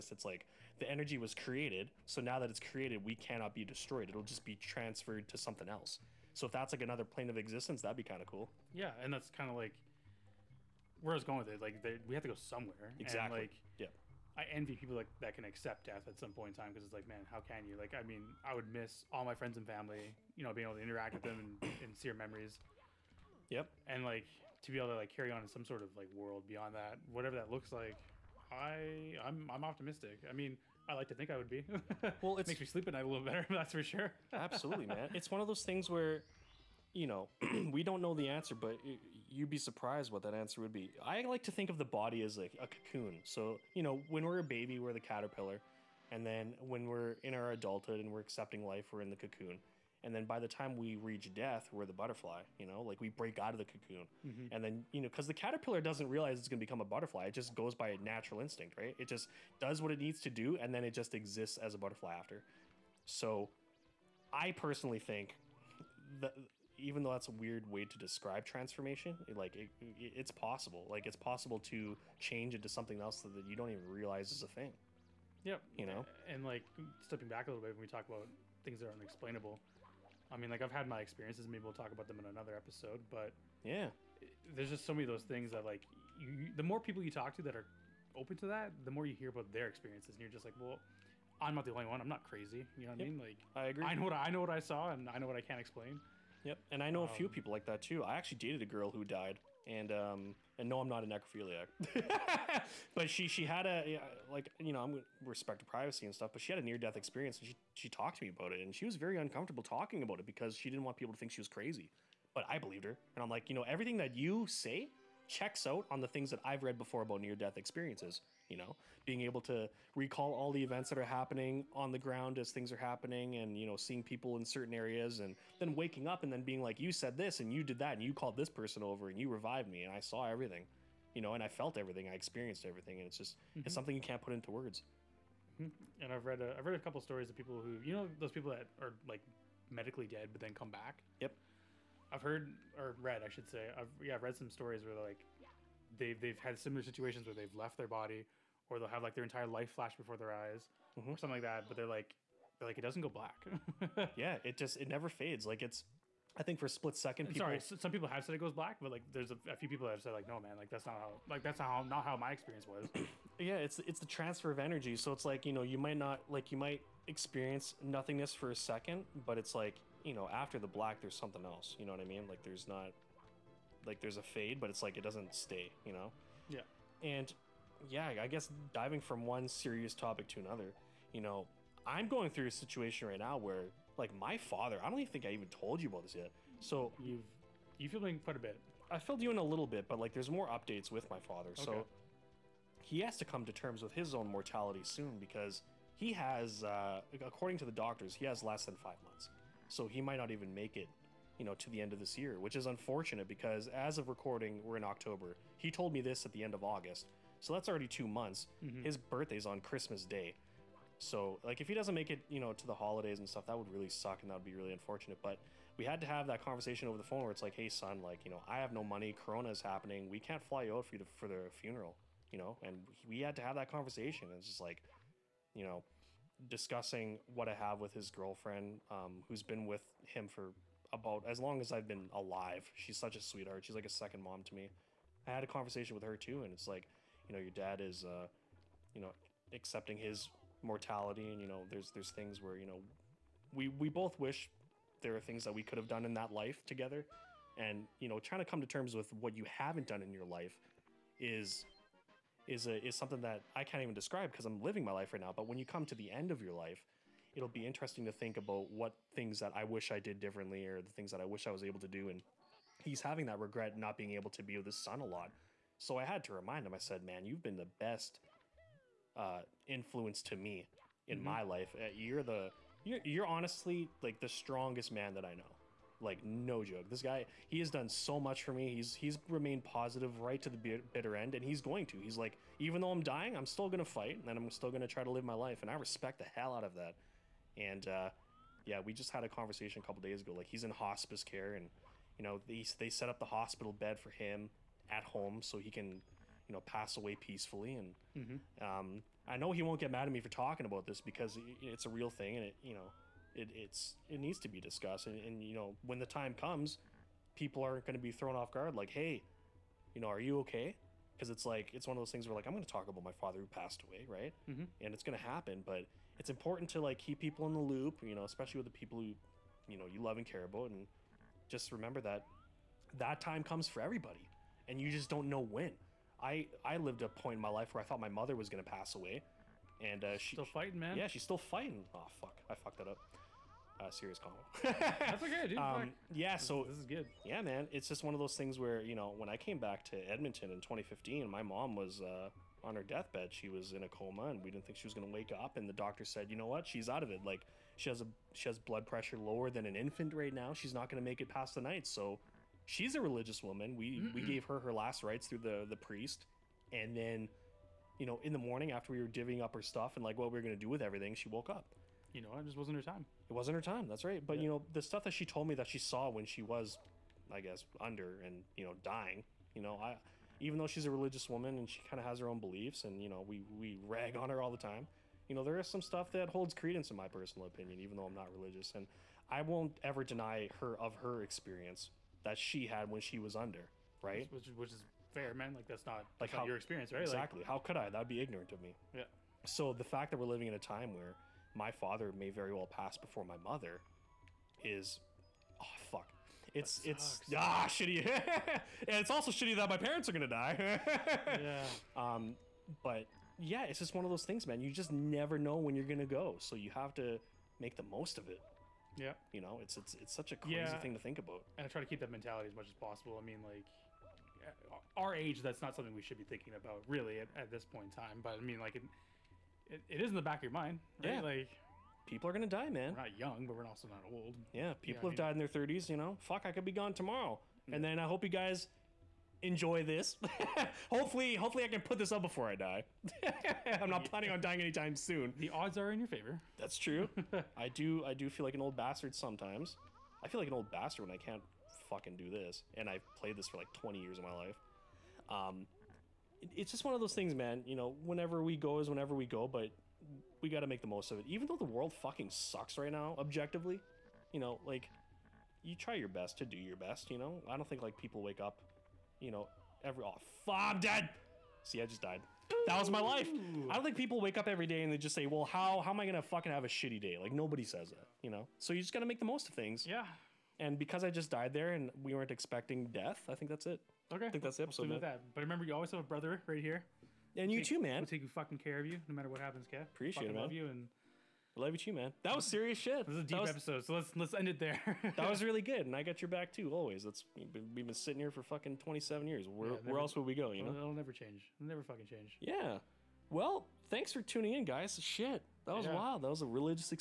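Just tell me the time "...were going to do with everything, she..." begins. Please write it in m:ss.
6:00.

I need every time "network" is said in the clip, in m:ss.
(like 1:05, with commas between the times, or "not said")
not said.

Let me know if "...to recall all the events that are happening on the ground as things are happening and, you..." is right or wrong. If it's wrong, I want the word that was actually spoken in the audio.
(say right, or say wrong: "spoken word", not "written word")
right.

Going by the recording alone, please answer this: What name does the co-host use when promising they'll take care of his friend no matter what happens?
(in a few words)
Kev.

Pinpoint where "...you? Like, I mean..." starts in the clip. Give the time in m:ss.
0:17.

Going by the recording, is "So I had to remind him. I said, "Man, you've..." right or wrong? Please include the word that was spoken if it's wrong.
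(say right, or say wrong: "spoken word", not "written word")
right.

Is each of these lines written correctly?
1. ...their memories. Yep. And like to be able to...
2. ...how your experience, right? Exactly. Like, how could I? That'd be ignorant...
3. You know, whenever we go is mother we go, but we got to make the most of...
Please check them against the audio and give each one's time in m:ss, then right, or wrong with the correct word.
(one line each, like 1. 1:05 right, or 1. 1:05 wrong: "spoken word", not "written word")
1. 0:22 right
2. 6:26 right
3. 7:27 wrong: "whenever", not "mother".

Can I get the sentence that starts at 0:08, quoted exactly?
Yeah, and that's kind of like where I was going with it.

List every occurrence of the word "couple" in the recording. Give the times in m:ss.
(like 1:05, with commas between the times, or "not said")
2:16, 4:49.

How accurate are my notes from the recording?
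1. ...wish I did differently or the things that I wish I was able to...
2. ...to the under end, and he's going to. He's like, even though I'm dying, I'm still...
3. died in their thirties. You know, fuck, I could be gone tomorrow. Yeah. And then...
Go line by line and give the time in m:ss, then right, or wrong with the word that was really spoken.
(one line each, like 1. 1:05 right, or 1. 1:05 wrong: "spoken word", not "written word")
1. 4:19 right
2. 4:40 wrong: "bitter", not "under"
3. 7:05 right.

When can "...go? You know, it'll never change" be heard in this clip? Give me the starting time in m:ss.
8:10.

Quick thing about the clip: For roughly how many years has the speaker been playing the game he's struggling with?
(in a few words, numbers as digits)
20 years.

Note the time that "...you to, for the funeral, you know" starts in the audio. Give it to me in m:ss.
3:40.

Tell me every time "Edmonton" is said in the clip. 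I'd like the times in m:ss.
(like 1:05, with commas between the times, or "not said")
5:39.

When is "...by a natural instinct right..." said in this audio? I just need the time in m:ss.
0:57.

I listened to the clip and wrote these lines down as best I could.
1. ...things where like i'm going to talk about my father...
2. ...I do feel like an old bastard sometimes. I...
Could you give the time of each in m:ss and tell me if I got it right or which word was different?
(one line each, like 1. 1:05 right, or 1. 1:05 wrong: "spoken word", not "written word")
1. 5:12 right
2. 7:18 right.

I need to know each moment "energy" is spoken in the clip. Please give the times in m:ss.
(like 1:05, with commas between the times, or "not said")
0:00, 2:44.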